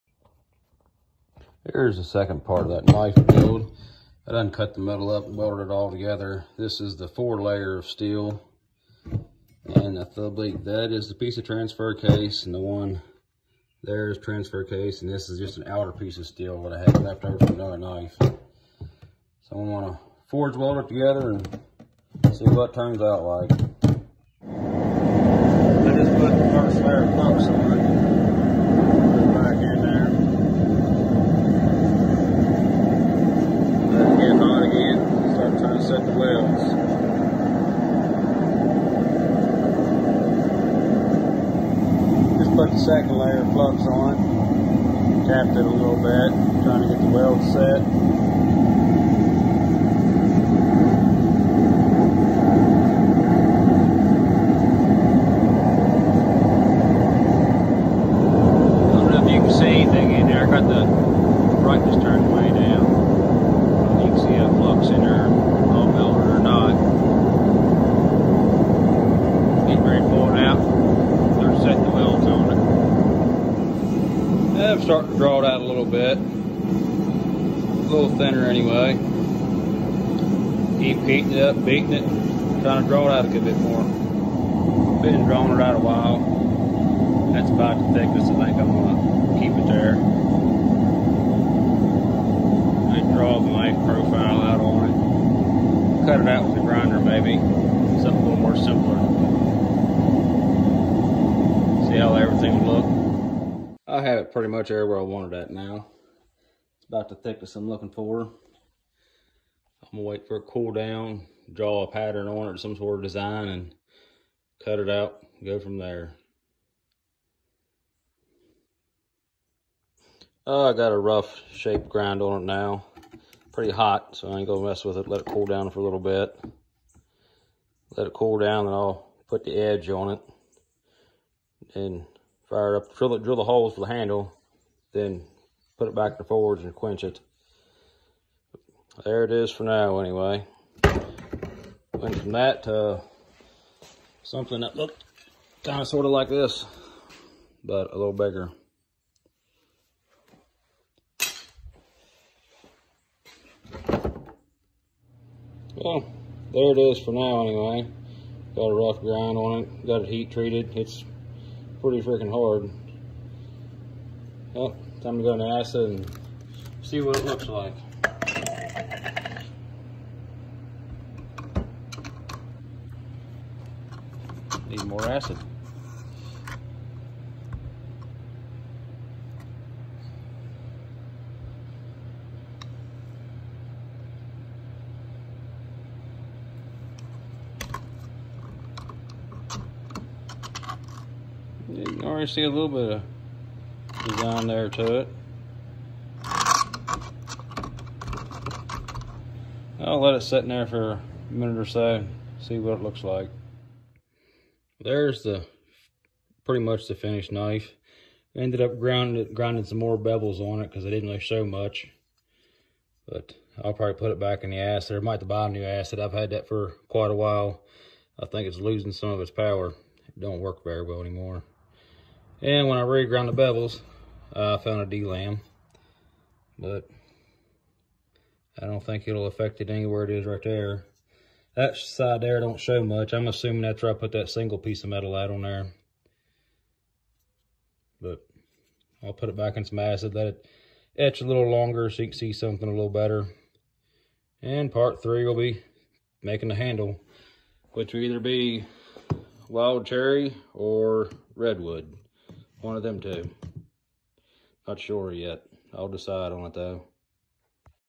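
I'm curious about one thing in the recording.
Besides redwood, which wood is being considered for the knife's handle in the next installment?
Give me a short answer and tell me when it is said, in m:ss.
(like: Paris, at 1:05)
wild cherry, at 4:09.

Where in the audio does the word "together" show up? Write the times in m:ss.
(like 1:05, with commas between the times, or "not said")
0:05, 0:20.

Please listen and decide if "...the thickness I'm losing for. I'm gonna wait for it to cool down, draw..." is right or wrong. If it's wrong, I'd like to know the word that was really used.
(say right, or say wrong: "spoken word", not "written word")
wrong: "looking", not "losing".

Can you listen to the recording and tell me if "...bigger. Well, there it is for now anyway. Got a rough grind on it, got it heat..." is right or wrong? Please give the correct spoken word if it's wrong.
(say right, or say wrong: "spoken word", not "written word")
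right.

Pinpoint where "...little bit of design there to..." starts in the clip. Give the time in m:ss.
3:12.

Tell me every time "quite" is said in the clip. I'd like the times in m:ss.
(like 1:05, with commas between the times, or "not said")
3:36.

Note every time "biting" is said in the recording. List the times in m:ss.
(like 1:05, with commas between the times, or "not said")
not said.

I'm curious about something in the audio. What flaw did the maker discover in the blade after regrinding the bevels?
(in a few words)
a lam.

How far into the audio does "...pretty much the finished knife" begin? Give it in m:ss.
3:26.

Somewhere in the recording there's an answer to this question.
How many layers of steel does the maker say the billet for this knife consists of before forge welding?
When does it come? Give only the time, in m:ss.
0:07.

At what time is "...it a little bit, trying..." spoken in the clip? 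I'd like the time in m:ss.
0:45.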